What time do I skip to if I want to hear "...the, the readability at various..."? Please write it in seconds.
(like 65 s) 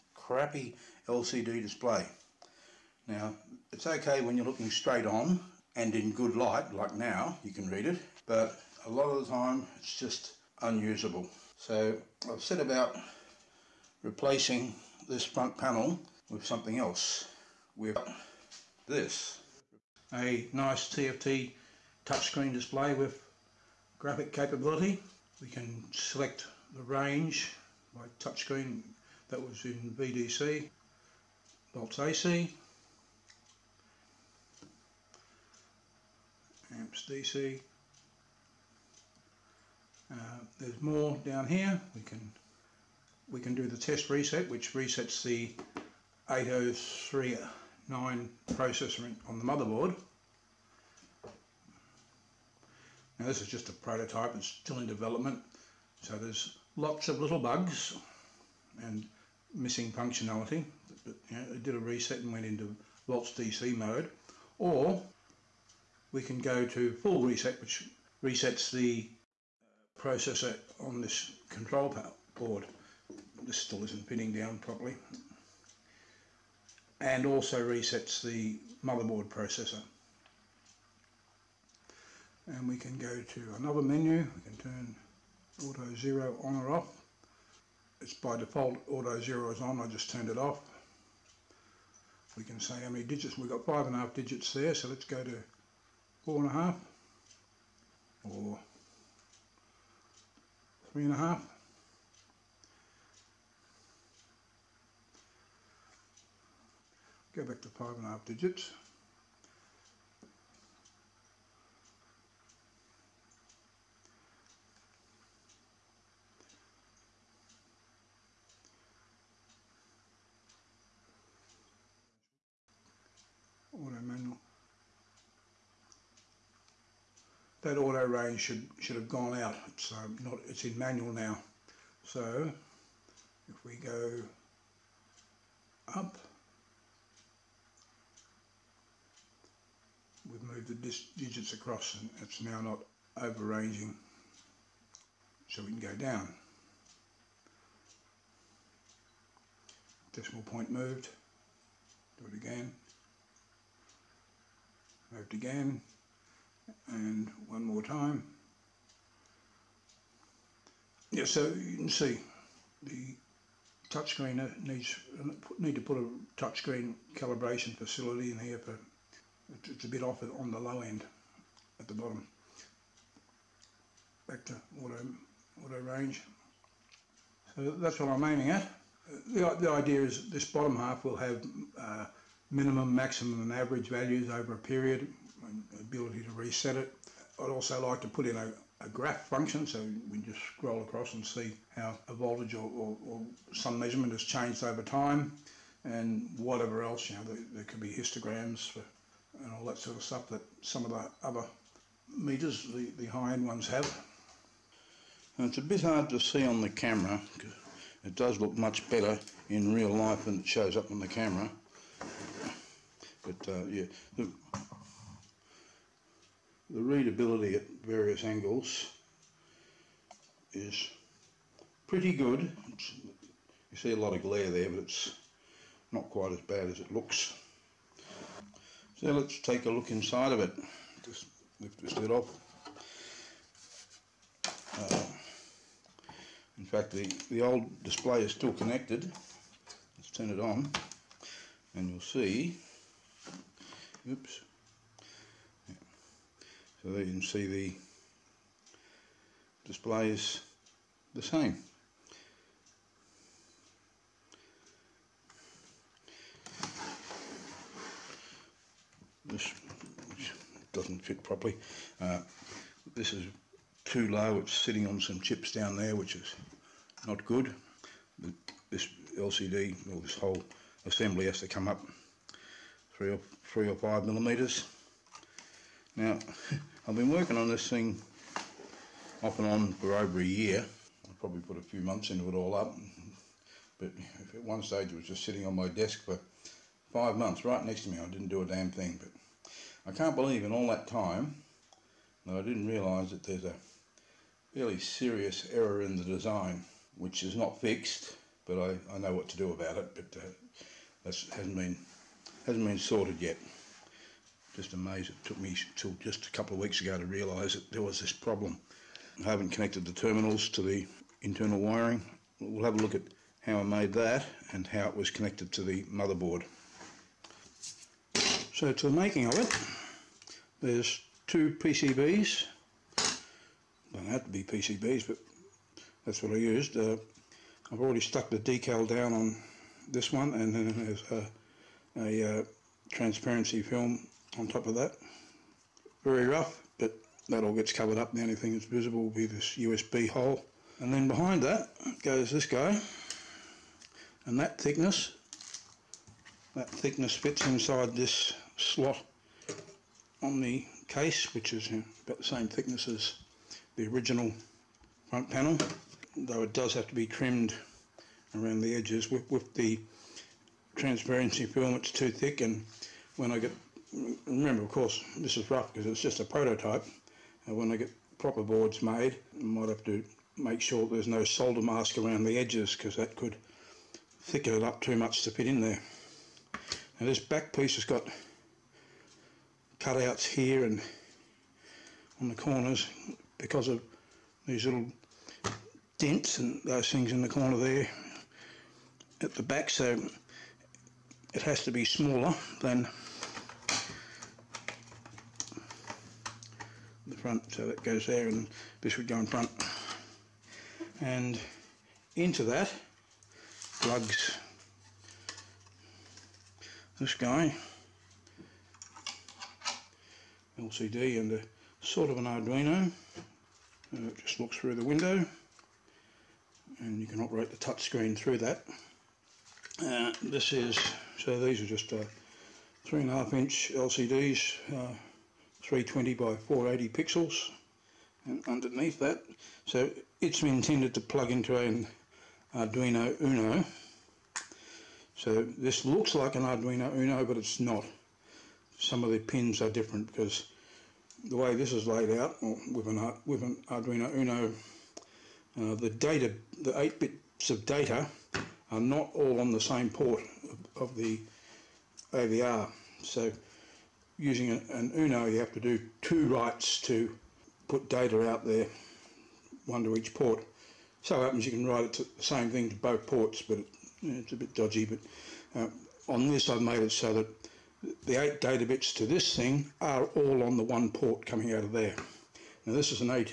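214 s.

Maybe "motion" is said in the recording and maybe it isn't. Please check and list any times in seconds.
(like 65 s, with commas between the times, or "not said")
not said.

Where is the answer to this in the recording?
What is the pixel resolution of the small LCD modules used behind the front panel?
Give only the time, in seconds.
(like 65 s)
425 s.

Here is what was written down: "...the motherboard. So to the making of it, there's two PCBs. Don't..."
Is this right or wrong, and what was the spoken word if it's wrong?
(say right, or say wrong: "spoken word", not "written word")
right.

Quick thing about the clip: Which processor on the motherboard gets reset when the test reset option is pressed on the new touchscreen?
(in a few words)
8039.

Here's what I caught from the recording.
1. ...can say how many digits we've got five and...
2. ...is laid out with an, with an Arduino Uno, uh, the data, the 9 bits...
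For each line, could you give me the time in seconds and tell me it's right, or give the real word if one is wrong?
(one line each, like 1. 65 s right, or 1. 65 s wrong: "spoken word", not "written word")
1. 92 s right
2. 441 s wrong: "8", not "9".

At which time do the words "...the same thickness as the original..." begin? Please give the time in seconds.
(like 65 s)
352 s.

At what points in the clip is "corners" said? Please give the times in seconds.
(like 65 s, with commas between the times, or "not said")
382 s, 387 s.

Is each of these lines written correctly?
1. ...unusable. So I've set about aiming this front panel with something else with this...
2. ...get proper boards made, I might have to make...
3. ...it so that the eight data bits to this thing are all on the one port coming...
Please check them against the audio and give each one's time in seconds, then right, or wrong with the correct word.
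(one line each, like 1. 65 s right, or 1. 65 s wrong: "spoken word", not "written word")
1. 10 s wrong: "replacing", not "aiming"
2. 367 s right
3. 466 s right.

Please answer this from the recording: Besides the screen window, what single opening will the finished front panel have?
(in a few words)
USB hole.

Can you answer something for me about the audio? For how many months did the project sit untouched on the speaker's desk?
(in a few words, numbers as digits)
5 months.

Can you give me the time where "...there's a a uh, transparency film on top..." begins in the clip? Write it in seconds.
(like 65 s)
330 s.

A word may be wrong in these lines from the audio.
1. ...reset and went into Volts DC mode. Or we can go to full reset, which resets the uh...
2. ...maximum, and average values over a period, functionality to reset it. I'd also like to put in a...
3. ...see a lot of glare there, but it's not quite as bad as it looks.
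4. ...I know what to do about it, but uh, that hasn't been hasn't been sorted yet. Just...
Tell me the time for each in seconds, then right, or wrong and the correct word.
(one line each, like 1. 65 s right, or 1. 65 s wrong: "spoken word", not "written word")
1. 61 s right
2. 182 s wrong: "ability", not "functionality"
3. 223 s right
4. 298 s right.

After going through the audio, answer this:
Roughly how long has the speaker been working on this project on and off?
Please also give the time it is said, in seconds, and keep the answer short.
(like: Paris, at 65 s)
Over a year, at 279 s.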